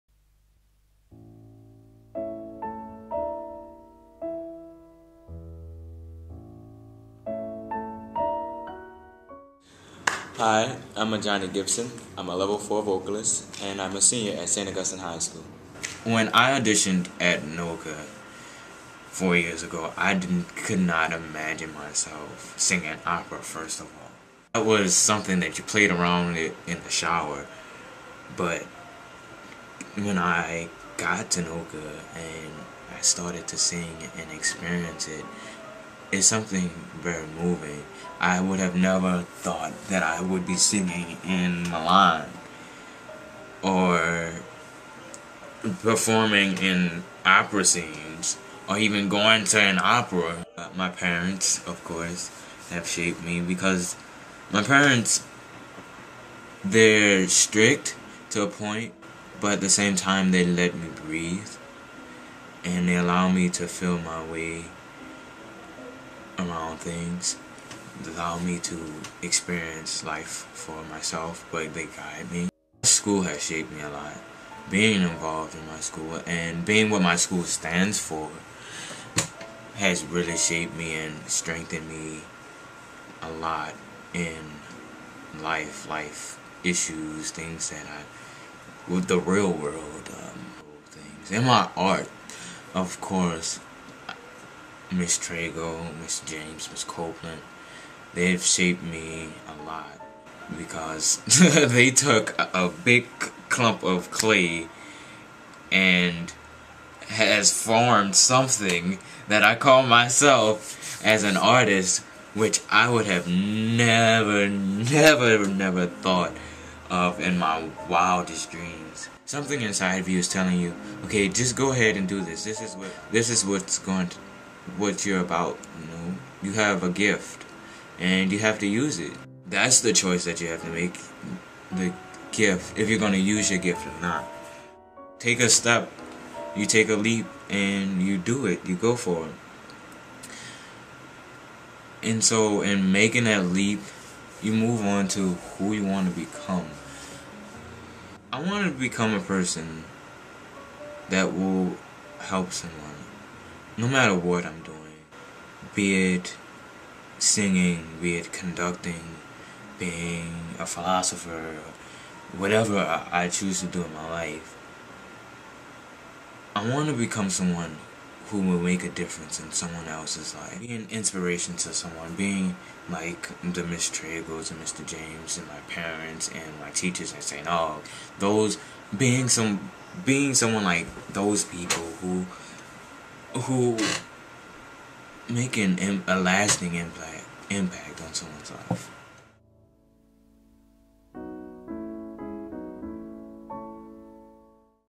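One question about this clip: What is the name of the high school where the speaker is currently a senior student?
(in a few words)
St. Augustine High School.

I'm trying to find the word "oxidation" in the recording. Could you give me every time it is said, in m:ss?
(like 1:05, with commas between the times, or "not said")
not said.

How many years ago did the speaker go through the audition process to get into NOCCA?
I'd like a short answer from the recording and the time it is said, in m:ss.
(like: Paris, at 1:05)
4, at 0:19.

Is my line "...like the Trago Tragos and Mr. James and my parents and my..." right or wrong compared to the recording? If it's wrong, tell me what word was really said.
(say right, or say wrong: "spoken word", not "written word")
wrong: "Miss", not "Trago".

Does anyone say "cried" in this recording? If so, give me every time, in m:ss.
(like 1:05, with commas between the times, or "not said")
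not said.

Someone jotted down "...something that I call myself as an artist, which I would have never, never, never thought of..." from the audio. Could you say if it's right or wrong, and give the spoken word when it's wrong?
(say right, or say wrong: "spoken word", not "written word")
right.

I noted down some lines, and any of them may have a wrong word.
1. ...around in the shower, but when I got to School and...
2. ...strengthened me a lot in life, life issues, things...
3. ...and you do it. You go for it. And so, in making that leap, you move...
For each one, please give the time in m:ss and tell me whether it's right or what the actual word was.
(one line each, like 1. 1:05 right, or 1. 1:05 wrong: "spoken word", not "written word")
1. 0:25 wrong: "NOCCA", not "School"
2. 1:21 right
3. 2:17 right.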